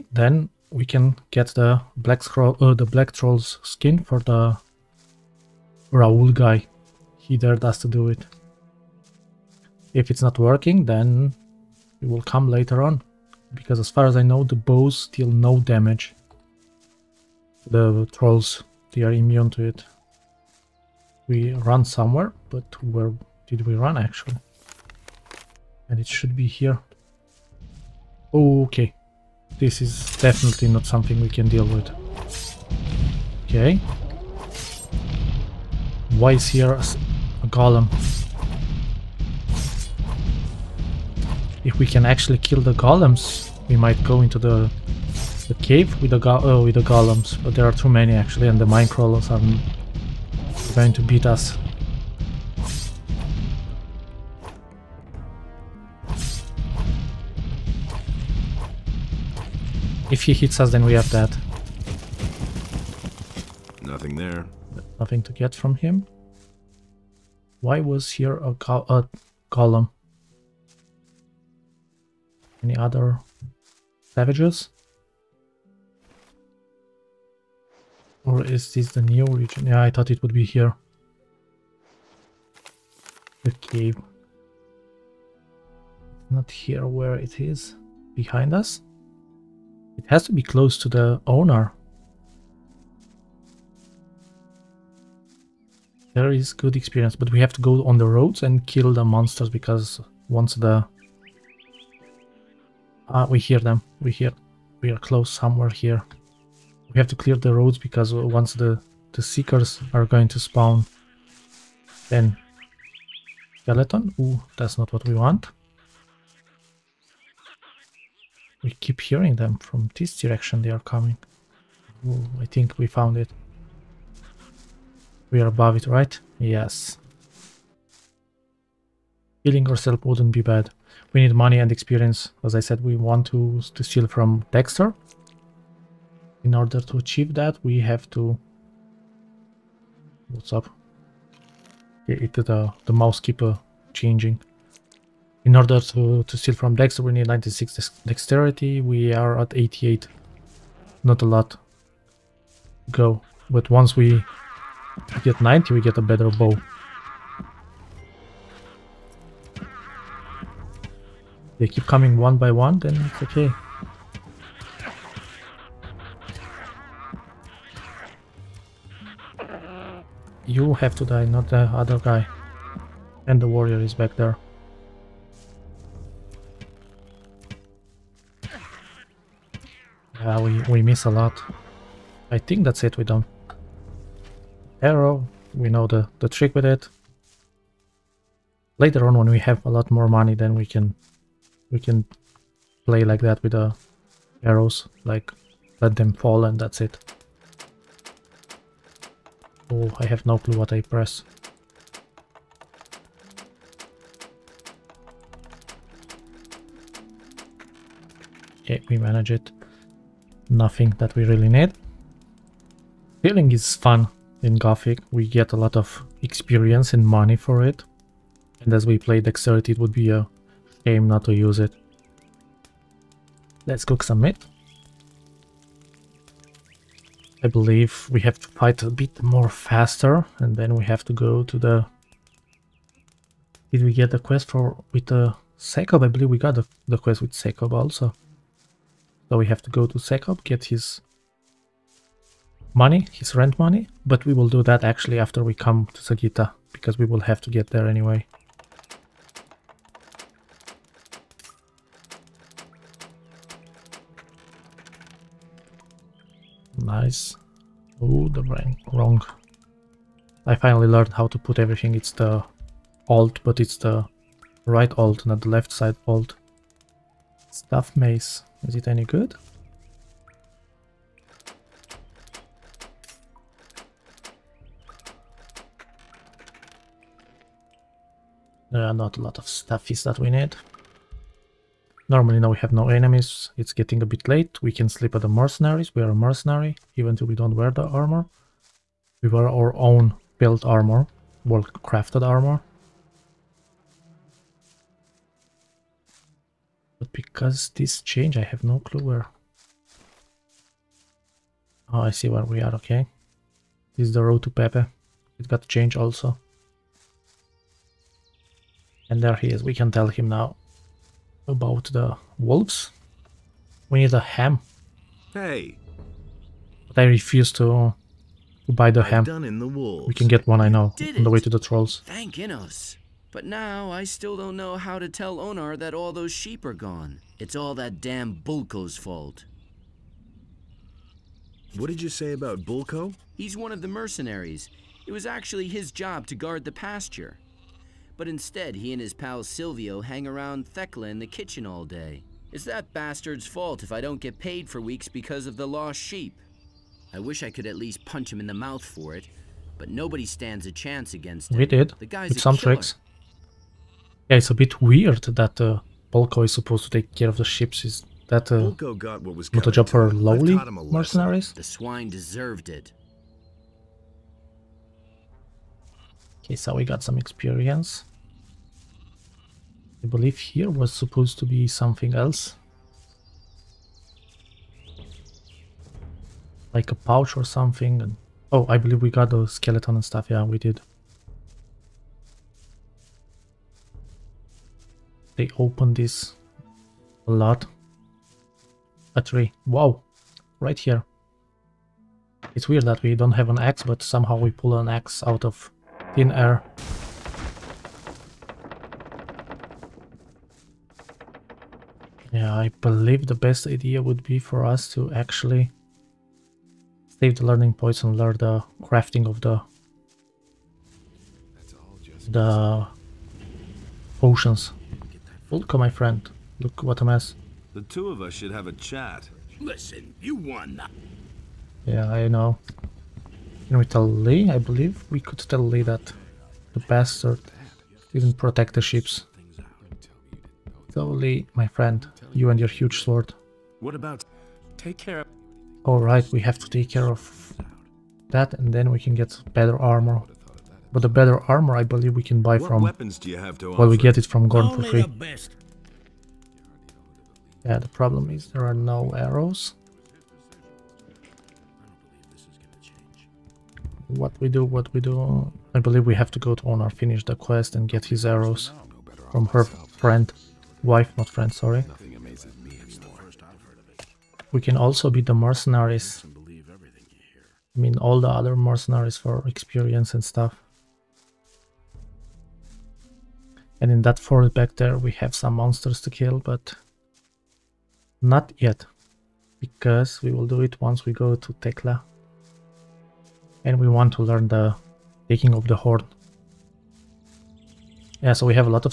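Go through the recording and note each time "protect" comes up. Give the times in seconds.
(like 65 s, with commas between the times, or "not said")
428 s.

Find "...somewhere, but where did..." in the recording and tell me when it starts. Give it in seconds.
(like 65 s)
21 s.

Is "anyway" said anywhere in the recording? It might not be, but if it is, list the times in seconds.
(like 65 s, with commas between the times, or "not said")
247 s.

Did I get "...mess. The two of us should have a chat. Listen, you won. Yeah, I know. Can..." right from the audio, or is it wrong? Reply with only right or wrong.
right.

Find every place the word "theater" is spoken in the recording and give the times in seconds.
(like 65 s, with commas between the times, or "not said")
not said.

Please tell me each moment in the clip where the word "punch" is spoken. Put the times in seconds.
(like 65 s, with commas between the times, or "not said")
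348 s.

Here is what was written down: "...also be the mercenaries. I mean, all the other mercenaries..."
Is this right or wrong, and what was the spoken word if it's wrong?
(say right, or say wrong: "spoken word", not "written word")
right.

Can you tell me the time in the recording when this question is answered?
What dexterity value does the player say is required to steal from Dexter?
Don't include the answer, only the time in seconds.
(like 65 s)
147 s.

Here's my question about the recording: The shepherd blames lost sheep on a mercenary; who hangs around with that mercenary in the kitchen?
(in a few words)
Silvio.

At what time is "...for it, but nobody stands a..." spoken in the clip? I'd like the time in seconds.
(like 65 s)
348 s.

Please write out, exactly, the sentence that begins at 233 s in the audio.
Did we get the quest for with the Sekob?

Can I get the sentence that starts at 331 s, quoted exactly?
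What did you say about Bulko?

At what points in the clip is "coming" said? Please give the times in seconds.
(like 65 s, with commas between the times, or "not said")
120 s, 161 s.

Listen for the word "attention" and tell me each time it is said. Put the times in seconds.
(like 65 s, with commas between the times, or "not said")
not said.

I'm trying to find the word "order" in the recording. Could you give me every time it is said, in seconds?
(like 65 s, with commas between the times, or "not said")
136 s, 145 s.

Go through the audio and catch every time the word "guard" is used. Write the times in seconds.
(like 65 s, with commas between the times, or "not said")
336 s.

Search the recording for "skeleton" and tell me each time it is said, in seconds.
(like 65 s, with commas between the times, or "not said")
113 s, 379 s.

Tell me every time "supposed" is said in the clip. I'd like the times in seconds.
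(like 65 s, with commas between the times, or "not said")
356 s, 370 s.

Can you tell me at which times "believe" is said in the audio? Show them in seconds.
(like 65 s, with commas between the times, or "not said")
227 s, 236 s, 370 s, 378 s, 402 s, 424 s, 441 s, 455 s.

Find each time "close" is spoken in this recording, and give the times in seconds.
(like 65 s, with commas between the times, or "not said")
90 s, 104 s.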